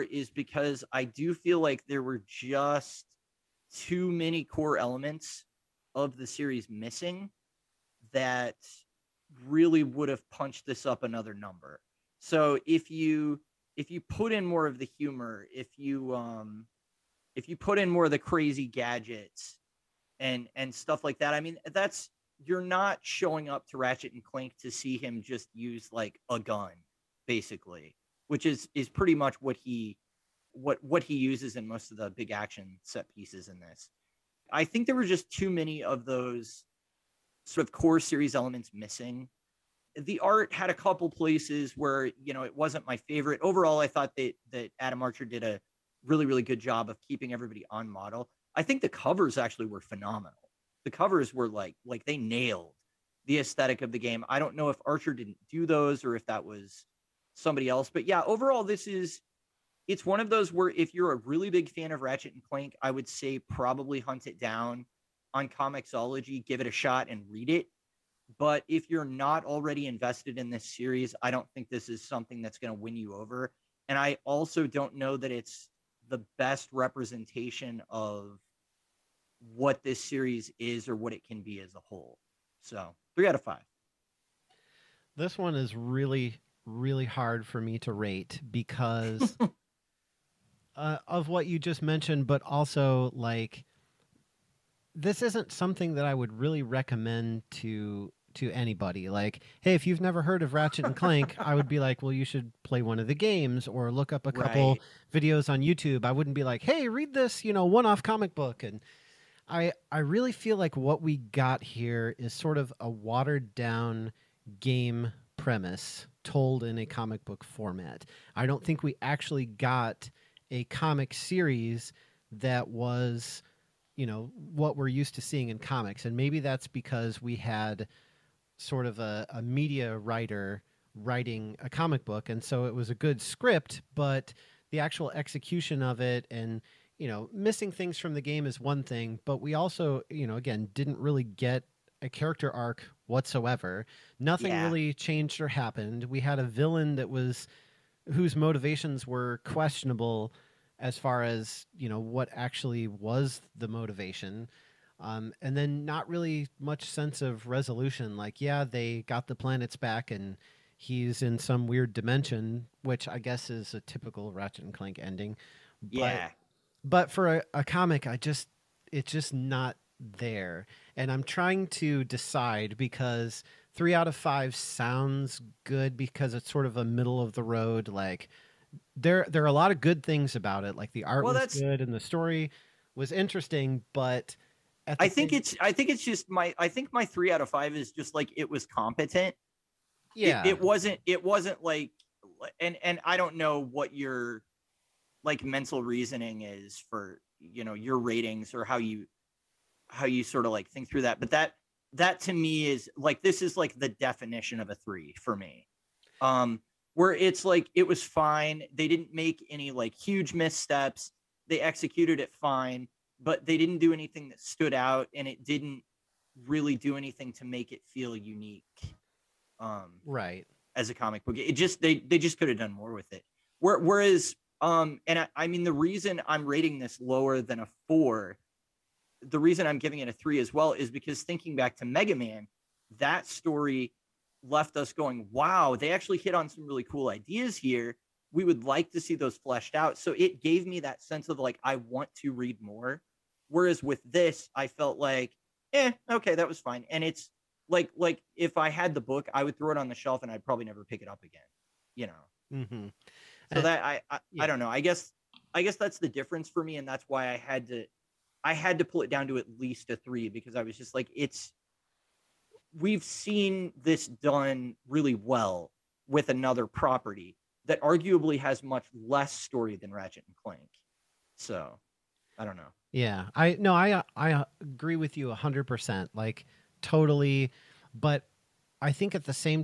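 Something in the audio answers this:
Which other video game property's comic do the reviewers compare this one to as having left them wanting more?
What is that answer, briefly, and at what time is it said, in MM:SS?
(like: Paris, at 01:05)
Mega Man, at 03:51.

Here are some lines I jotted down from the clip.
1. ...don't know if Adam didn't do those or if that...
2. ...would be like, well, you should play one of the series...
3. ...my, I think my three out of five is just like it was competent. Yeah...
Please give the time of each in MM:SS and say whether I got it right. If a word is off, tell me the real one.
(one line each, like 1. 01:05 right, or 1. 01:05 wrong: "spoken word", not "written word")
1. 00:54 wrong: "Archer", not "Adam"
2. 01:41 wrong: "games", not "series"
3. 03:06 right.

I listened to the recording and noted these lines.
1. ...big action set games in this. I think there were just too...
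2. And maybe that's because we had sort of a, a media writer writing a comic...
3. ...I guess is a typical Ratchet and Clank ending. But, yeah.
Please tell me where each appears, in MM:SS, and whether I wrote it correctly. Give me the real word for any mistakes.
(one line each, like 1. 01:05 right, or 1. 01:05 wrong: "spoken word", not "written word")
1. 00:32 wrong: "pieces", not "games"
2. 02:06 right
3. 02:43 right.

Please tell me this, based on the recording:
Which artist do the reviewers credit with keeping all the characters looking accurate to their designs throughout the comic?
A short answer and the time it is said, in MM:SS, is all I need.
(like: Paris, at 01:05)
Adam Archer, at 00:44.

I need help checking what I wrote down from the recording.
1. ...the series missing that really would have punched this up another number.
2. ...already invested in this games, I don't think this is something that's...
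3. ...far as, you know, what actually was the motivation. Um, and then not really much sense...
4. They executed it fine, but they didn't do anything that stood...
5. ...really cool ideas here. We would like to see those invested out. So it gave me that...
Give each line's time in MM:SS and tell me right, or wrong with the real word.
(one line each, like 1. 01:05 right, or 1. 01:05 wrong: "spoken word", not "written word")
1. 00:06 right
2. 01:09 wrong: "series", not "games"
3. 02:30 right
4. 03:31 right
5. 03:56 wrong: "fleshed", not "invested".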